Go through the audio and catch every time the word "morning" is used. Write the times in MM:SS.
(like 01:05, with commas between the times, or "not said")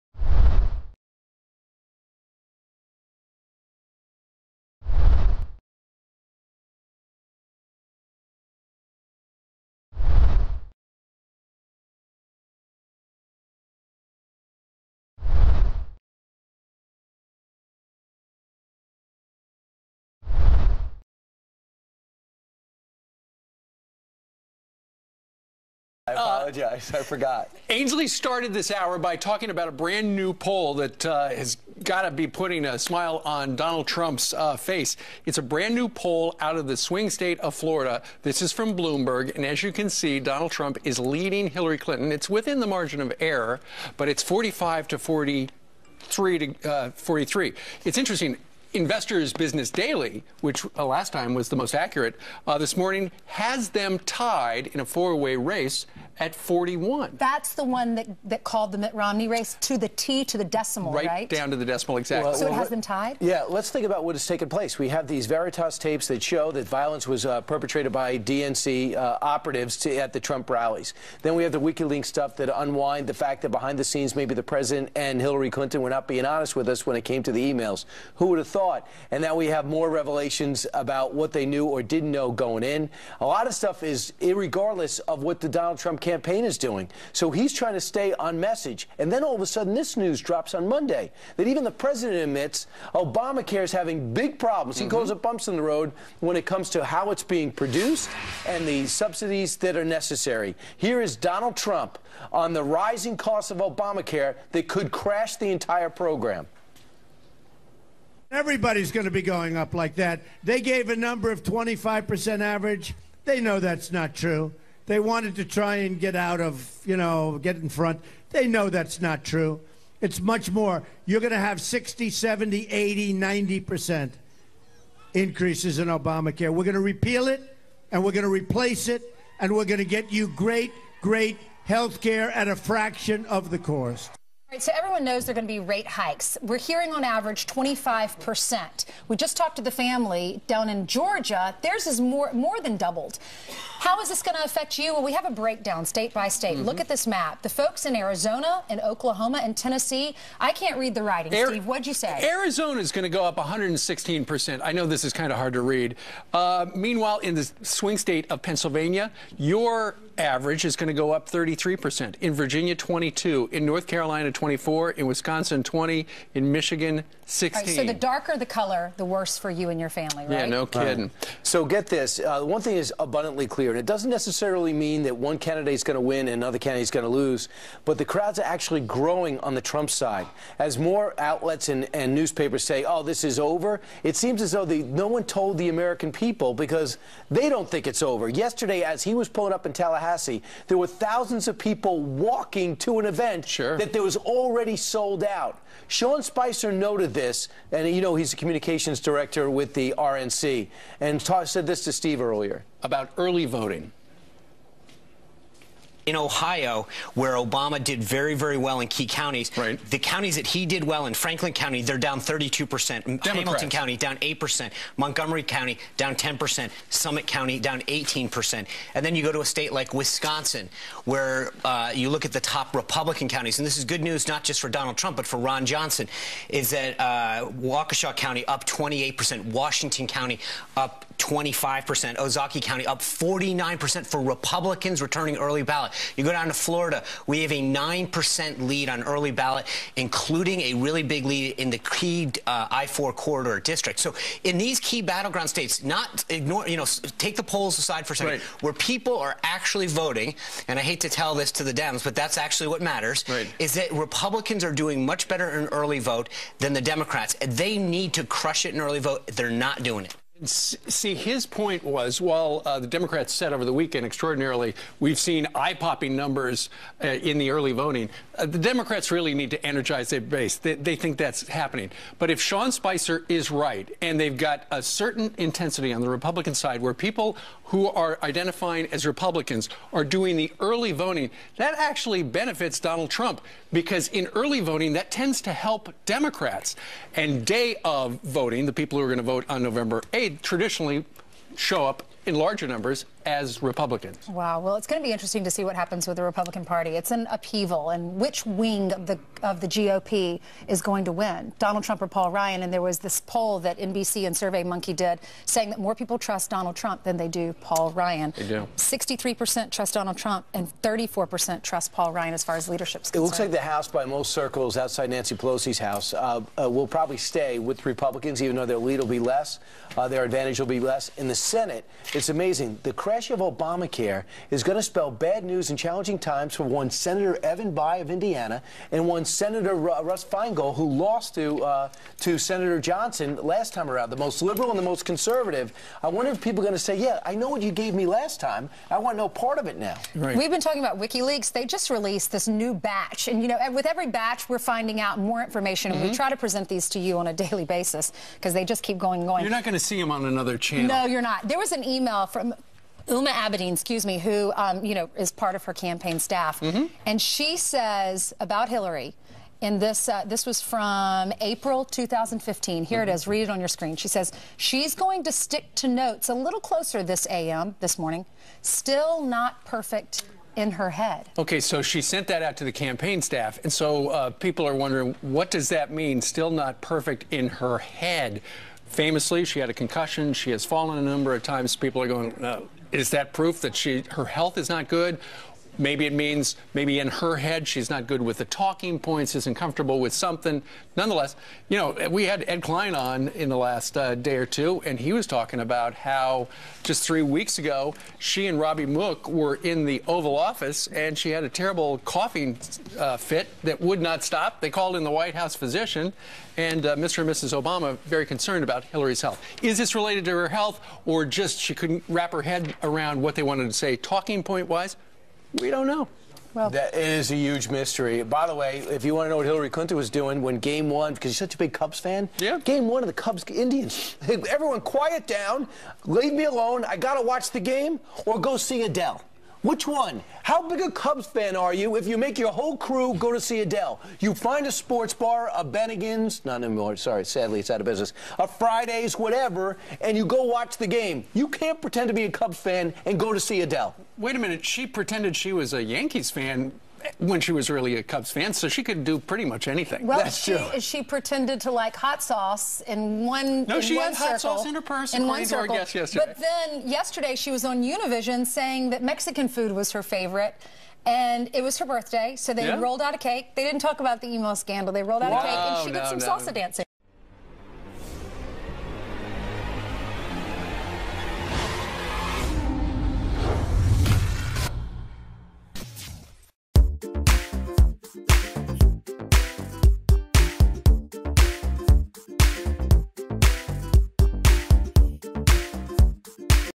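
00:52, 06:07.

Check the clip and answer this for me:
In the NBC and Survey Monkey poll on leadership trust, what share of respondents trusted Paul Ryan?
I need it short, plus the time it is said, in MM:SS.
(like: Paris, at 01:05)
34%, at 05:10.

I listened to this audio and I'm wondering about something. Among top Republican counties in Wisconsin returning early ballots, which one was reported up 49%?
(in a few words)
Ozaukee County.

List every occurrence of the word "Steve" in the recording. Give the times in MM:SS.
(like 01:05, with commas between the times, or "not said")
02:31, 03:21.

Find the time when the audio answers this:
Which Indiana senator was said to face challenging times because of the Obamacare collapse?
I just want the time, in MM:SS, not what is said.
05:27.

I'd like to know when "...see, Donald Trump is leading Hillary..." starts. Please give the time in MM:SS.
00:39.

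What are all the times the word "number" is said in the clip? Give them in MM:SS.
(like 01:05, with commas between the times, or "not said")
01:50, 04:26, 04:52, 06:21.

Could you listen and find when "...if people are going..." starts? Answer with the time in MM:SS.
05:36.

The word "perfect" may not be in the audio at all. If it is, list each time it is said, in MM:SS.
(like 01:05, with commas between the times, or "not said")
06:09, 06:16.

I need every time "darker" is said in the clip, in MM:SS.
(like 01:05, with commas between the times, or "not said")
02:47.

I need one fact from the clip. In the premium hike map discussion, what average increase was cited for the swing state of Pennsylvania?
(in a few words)
33%.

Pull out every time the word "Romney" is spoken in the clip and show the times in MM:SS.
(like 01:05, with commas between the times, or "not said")
00:58.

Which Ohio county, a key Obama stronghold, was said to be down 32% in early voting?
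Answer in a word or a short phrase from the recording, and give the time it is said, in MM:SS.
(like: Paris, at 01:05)
Franklin County, at 03:31.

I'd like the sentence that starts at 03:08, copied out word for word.
Yesterday, as he was pulling up in Tallahassee, there were thousands of people walking to an event sure.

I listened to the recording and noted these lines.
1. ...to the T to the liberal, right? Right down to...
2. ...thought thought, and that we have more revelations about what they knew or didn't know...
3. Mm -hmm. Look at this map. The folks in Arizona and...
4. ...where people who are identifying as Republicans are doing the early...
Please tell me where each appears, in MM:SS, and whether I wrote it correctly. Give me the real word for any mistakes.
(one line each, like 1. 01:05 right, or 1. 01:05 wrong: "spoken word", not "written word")
1. 00:59 wrong: "decimal", not "liberal"
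2. 01:18 right
3. 02:26 right
4. 04:36 right.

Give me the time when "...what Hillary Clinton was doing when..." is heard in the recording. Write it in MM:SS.
06:59.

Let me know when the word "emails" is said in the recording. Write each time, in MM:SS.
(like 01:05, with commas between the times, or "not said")
01:17, 05:51.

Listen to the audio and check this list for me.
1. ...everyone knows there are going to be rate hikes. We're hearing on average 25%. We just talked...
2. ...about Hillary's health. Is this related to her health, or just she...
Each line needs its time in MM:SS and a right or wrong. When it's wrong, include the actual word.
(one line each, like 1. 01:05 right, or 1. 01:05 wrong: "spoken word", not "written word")
1. 02:14 right
2. 06:48 right.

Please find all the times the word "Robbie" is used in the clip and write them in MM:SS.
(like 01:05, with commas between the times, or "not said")
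06:38.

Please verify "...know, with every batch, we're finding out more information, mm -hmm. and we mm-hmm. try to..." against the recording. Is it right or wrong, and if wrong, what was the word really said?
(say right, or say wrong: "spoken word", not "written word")
right.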